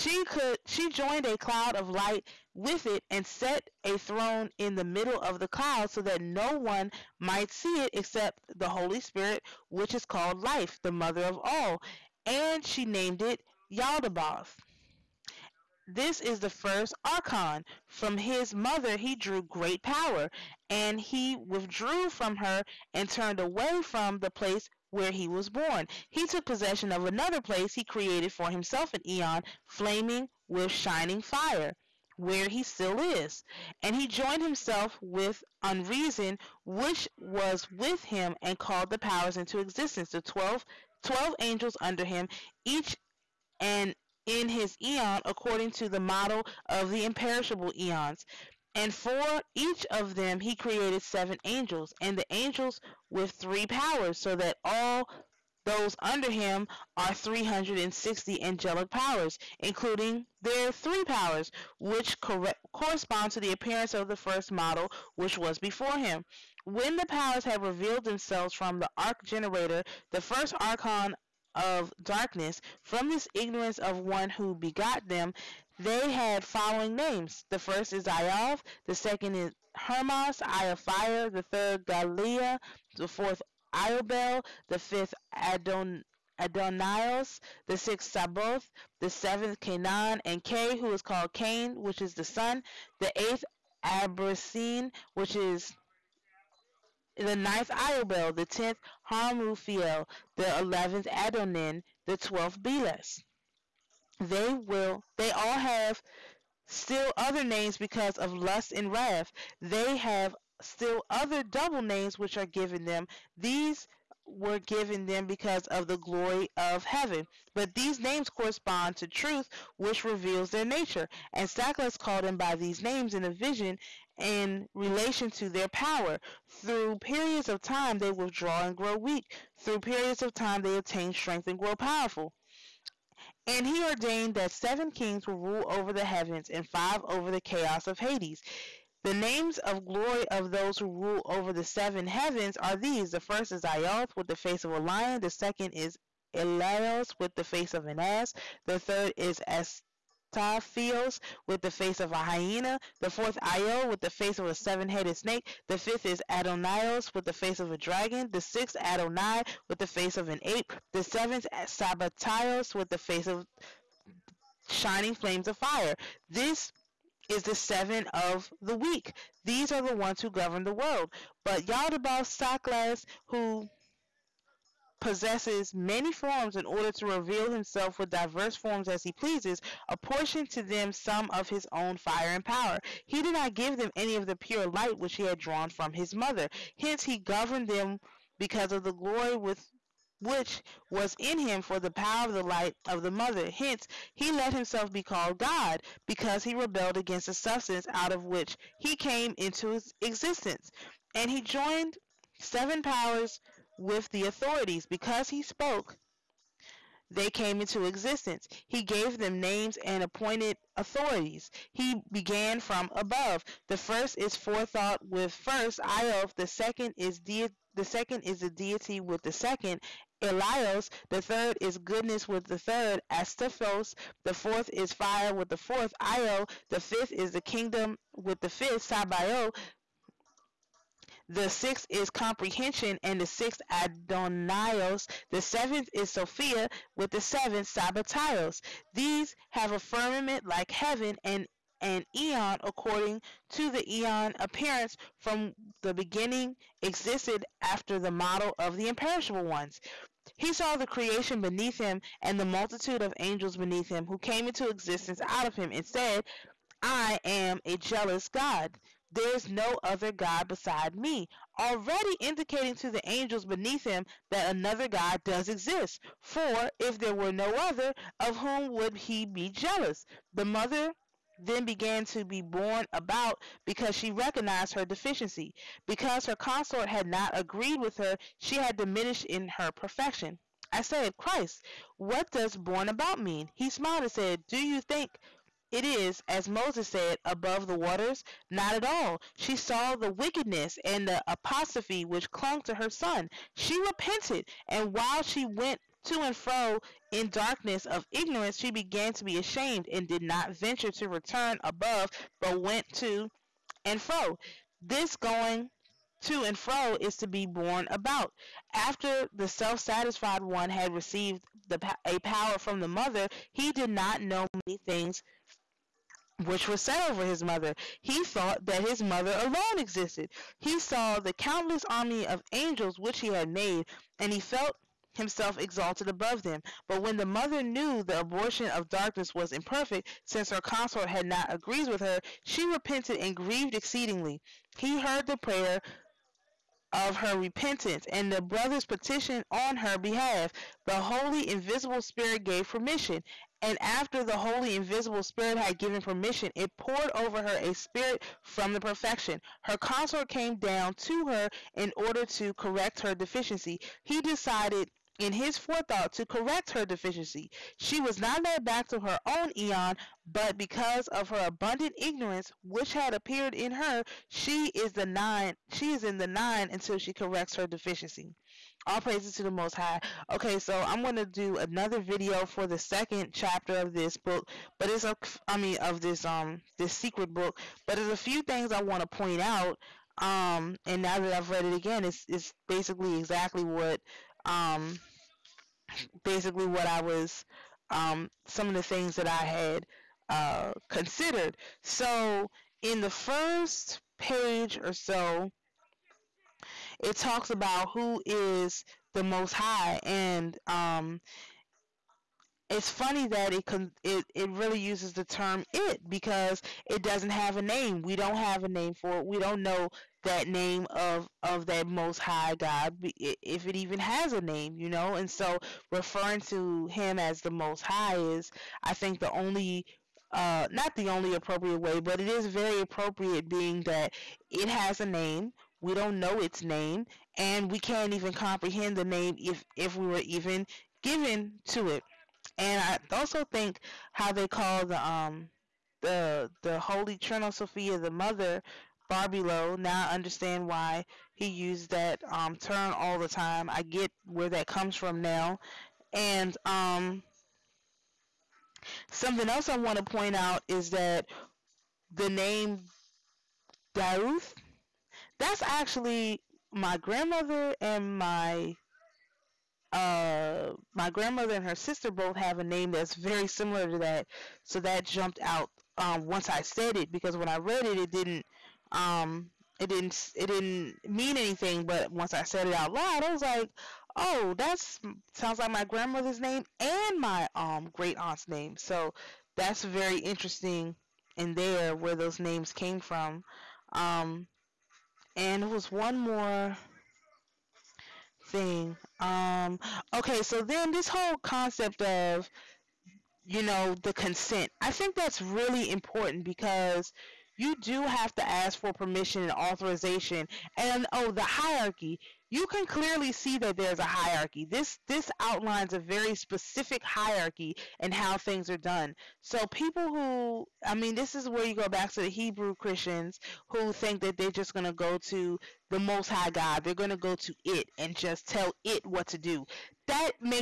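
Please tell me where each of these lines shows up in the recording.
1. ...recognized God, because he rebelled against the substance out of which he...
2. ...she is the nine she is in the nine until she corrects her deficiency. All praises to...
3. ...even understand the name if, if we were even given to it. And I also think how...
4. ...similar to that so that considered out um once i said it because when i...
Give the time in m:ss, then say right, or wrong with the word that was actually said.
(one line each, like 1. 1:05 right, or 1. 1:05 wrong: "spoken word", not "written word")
1. 3:15 wrong: "called", not "recognized"
2. 6:04 right
3. 7:08 wrong: "comprehend", not "understand"
4. 7:43 wrong: "jumped", not "considered".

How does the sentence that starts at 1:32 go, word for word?
the eighth Abrasine, which is the ninth Iobel, the tenth Harmuthiel, the eleventh Adonin, the twelfth Belus.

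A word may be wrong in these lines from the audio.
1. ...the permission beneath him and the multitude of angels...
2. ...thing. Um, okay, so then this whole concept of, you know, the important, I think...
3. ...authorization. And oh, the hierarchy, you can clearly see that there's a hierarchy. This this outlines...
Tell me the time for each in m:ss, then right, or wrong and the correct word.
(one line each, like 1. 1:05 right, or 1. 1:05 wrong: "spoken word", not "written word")
1. 4:10 wrong: "creation", not "permission"
2. 8:08 wrong: "consent", not "important"
3. 8:19 right.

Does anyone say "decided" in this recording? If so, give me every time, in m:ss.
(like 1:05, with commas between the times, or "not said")
5:54.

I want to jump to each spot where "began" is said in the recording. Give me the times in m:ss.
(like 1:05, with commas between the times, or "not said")
3:32, 4:31, 4:58.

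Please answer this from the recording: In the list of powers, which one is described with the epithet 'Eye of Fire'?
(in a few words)
Hermas.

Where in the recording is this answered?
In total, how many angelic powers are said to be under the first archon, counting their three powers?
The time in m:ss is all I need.
0:57.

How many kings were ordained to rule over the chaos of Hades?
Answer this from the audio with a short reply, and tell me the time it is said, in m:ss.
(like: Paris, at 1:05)
5, at 2:16.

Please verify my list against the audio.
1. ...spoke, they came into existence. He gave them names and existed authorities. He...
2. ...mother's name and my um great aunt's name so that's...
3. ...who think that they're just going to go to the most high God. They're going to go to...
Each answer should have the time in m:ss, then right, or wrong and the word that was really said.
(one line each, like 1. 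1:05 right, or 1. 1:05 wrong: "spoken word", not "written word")
1. 3:25 wrong: "appointed", not "existed"
2. 7:55 wrong: "grandmother", not "mother"
3. 8:33 right.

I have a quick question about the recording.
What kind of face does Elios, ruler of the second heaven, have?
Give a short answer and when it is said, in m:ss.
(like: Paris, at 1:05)
an ass, at 2:27.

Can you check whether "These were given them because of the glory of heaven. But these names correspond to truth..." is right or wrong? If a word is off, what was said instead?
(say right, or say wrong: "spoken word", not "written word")
right.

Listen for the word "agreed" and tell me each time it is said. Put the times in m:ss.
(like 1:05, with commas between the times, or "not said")
4:37, 5:31.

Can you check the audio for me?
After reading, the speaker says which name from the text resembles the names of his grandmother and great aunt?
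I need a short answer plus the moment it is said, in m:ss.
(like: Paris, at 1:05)
Dauth, at 7:33.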